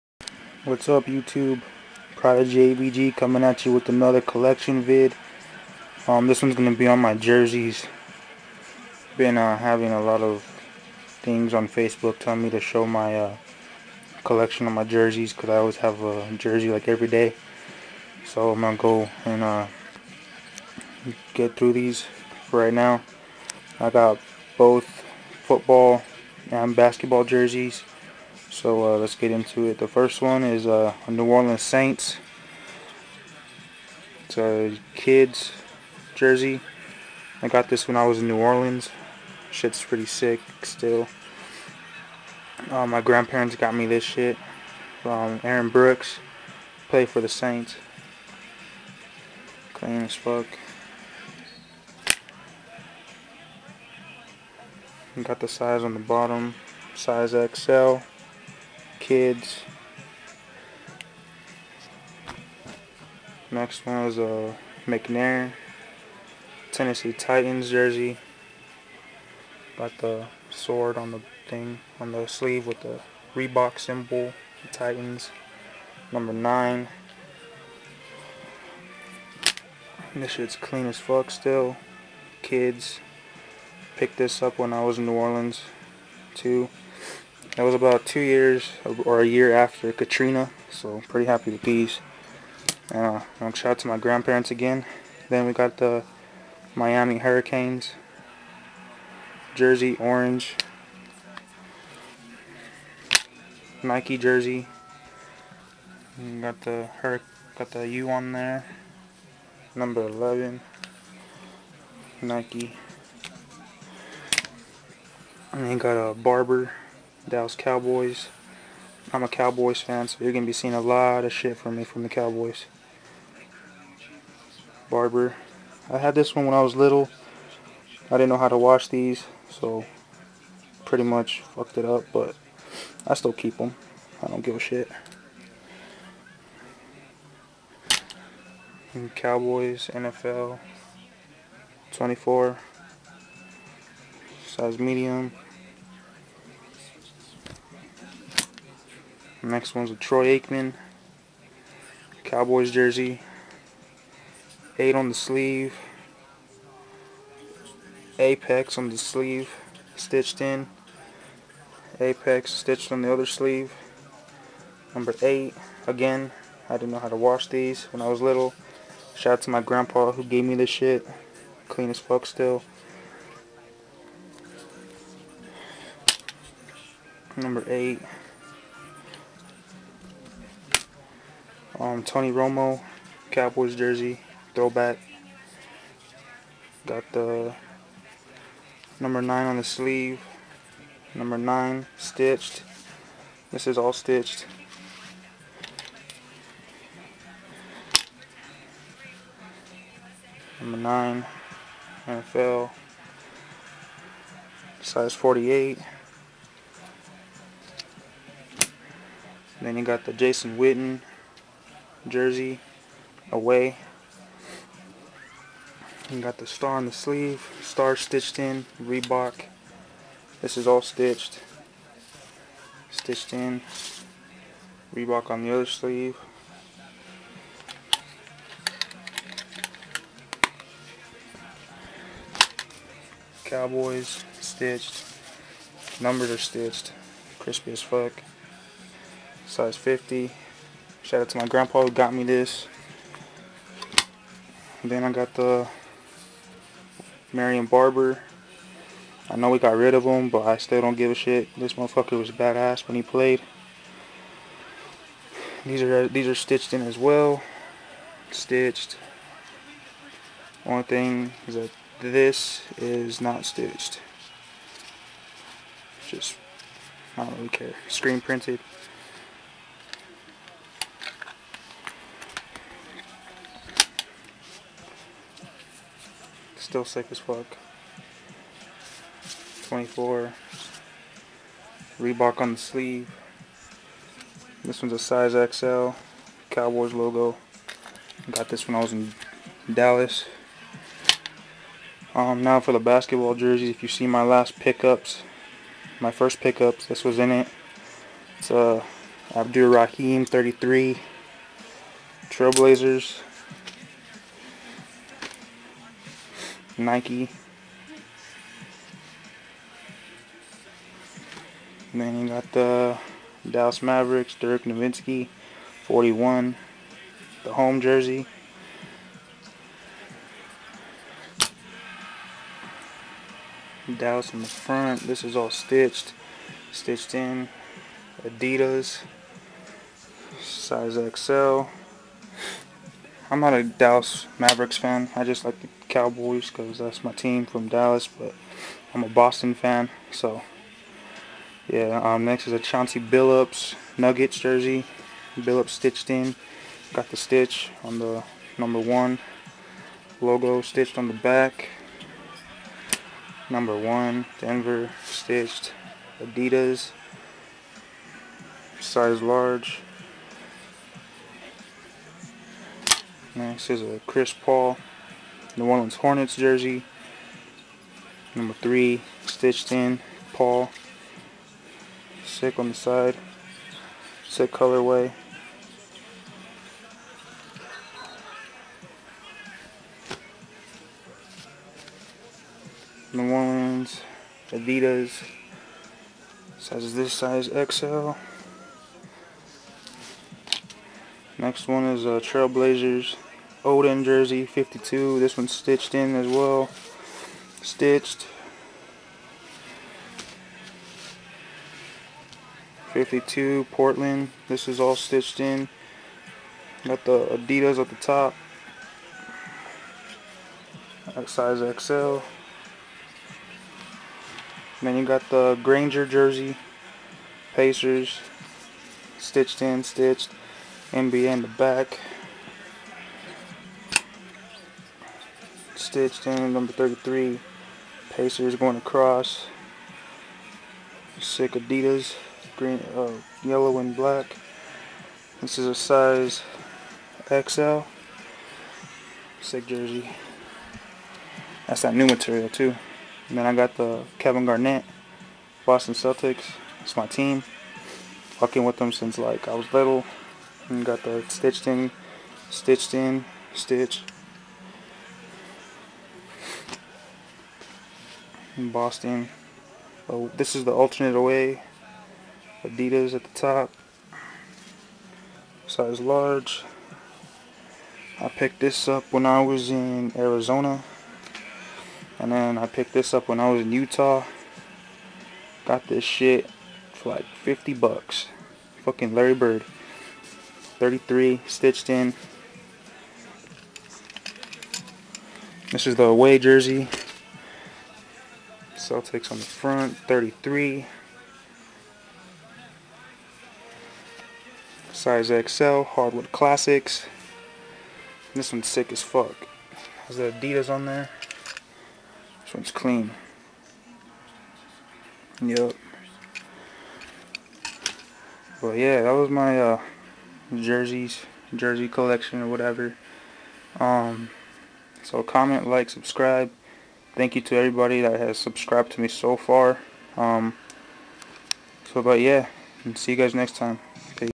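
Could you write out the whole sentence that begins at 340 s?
So, yeah, um, next is a Chauncey Billups Nuggets jersey.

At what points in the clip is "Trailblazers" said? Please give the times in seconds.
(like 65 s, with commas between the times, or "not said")
302 s, 392 s.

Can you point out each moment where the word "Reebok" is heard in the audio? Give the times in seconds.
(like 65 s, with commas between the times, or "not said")
73 s, 218 s, 224 s, 281 s.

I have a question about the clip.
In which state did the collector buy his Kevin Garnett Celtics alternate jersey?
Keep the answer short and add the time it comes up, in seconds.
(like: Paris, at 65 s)
Arizona, at 470 s.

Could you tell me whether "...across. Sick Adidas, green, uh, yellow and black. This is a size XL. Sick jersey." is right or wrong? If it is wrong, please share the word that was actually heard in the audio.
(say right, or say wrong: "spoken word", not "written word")
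right.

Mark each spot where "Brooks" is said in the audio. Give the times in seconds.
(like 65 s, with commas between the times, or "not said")
45 s.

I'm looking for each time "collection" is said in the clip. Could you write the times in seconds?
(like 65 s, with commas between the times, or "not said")
4 s, 14 s, 511 s.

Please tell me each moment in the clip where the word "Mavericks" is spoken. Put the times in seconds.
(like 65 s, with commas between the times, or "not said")
313 s, 334 s.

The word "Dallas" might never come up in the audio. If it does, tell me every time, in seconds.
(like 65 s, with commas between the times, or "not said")
117 s, 289 s, 313 s, 323 s, 333 s, 337 s.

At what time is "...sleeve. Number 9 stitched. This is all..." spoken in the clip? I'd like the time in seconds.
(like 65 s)
189 s.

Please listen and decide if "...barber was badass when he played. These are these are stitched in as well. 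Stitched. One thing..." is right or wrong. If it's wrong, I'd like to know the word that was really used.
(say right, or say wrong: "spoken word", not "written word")
wrong: "motherfucker", not "barber".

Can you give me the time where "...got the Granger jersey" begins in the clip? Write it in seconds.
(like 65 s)
415 s.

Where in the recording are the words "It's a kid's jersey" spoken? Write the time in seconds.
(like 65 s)
34 s.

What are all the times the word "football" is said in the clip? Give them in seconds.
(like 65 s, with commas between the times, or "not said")
25 s.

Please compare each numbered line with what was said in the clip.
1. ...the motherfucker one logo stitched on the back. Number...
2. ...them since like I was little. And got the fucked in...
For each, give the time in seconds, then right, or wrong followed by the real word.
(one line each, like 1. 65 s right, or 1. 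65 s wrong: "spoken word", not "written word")
1. 347 s wrong: "number", not "motherfucker"
2. 448 s wrong: "stitched", not "fucked".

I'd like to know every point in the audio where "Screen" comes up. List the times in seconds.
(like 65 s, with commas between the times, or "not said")
267 s.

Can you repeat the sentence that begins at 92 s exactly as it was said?
Uh, um, shout out to my grandparents again.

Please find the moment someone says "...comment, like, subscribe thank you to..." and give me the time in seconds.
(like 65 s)
515 s.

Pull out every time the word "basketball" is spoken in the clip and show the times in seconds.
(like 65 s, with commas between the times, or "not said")
26 s, 292 s.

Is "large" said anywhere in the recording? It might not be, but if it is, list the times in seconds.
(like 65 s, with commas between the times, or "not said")
359 s, 466 s.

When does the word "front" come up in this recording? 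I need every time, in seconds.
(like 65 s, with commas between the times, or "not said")
324 s, 489 s.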